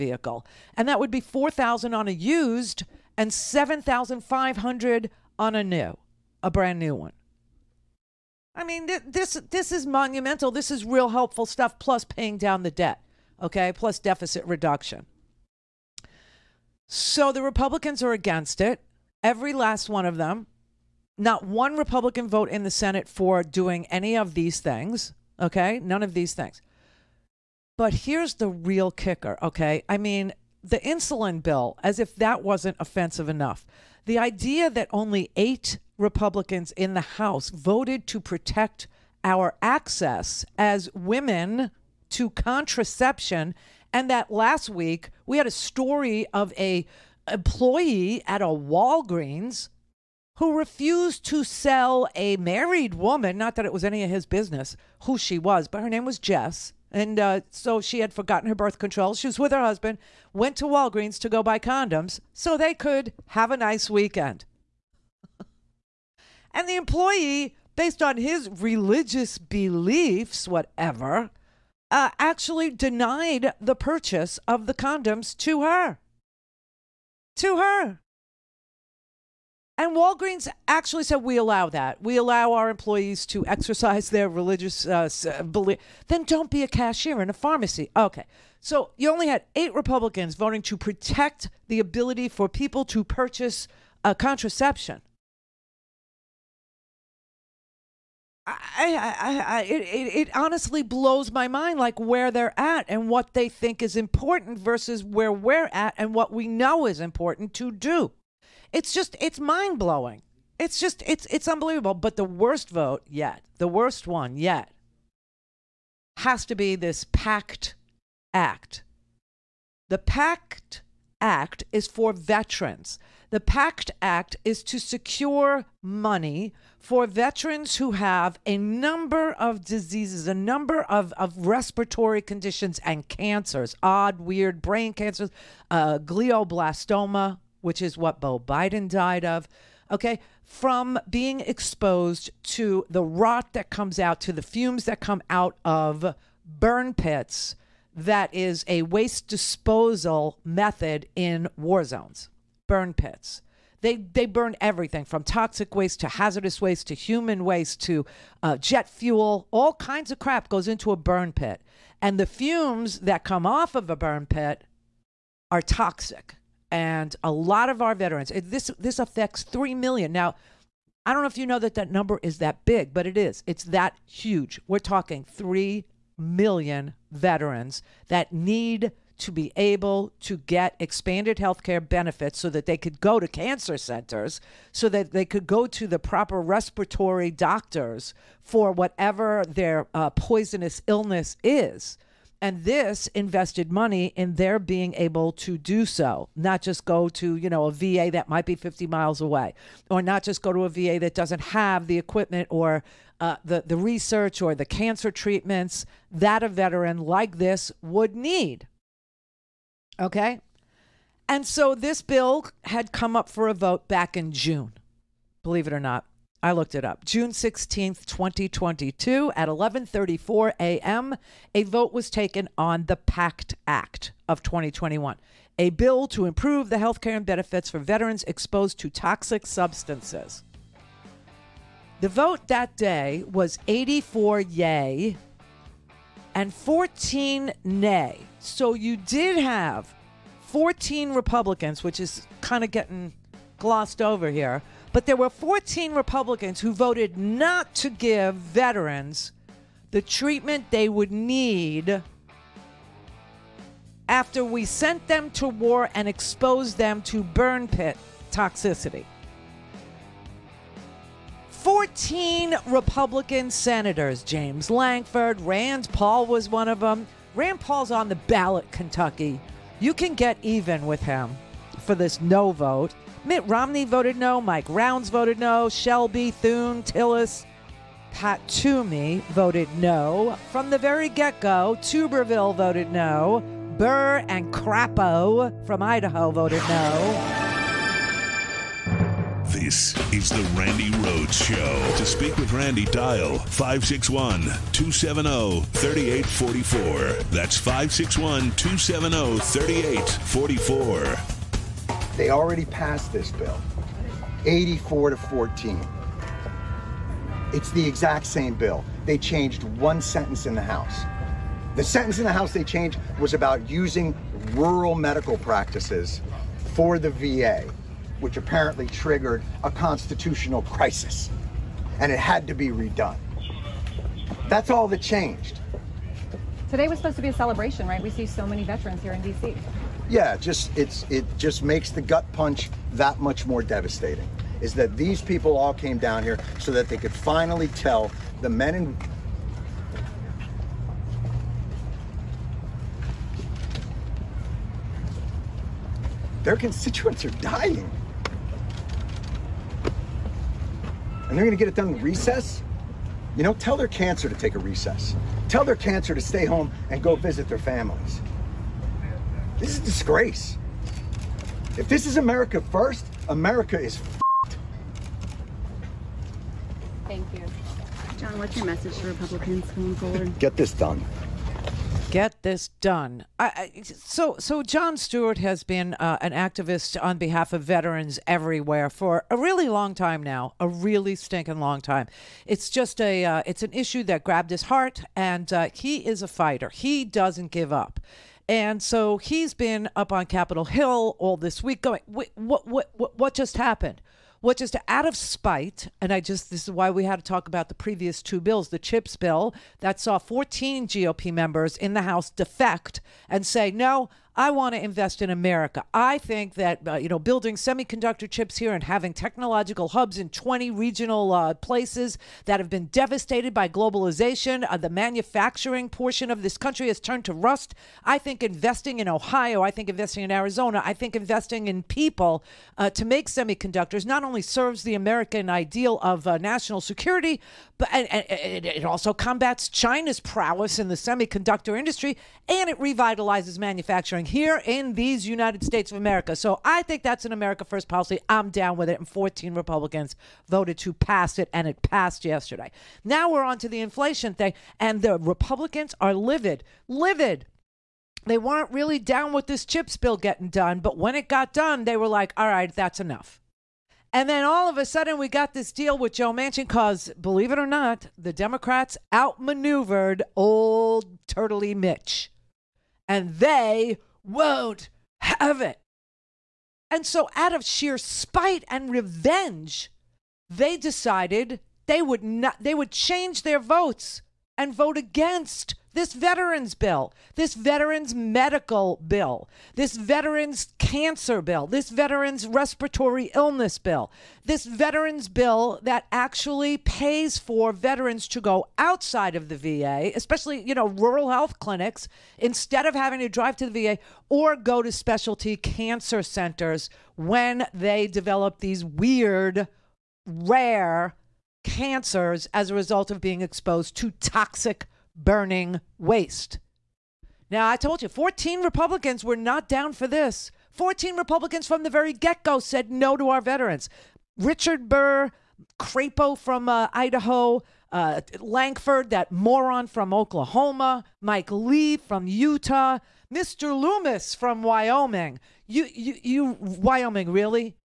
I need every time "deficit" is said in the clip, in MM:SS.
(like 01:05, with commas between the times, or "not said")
00:13.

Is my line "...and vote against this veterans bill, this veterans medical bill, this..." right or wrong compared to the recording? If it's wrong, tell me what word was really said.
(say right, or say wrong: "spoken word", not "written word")
right.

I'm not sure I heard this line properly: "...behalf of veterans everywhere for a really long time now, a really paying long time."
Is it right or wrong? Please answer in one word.
wrong.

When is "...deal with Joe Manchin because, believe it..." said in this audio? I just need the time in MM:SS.
07:35.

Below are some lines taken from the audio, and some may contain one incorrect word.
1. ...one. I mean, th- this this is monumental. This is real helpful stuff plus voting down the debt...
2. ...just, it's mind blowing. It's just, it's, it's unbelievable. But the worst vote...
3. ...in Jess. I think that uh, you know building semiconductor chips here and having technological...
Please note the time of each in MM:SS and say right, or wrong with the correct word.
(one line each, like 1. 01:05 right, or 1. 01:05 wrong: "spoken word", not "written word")
1. 00:06 wrong: "paying", not "voting"
2. 01:48 right
3. 06:45 wrong: "America", not "Jess".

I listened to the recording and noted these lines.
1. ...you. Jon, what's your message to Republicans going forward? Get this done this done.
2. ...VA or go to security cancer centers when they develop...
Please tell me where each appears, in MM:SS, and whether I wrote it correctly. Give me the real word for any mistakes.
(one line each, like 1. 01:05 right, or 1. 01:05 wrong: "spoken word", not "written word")
1. 06:07 right
2. 08:13 wrong: "specialty", not "security".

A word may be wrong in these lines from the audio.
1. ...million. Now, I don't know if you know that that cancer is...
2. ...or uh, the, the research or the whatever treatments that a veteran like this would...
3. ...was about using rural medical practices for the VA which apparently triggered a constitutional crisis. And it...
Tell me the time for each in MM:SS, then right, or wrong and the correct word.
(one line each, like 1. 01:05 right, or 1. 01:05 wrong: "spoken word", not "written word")
1. 02:49 wrong: "number", not "cancer"
2. 03:22 wrong: "cancer", not "whatever"
3. 05:13 right.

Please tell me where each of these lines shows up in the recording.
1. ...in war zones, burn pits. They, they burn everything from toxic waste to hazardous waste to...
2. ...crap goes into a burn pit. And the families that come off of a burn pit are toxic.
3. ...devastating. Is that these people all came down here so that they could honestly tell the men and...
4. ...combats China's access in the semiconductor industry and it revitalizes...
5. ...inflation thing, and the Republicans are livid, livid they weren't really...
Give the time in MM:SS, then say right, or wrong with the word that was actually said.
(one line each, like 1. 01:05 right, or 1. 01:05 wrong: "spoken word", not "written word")
1. 02:31 right
2. 02:40 wrong: "fumes", not "families"
3. 05:33 wrong: "finally", not "honestly"
4. 07:09 wrong: "prowess", not "access"
5. 07:23 right.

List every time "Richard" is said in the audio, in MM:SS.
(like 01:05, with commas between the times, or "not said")
08:34.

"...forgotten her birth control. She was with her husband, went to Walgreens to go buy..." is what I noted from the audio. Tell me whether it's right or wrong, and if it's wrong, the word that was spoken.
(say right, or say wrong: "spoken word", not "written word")
right.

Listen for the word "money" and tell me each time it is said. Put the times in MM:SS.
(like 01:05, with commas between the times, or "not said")
02:05, 03:13.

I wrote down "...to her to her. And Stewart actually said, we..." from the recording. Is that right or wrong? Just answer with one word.
wrong.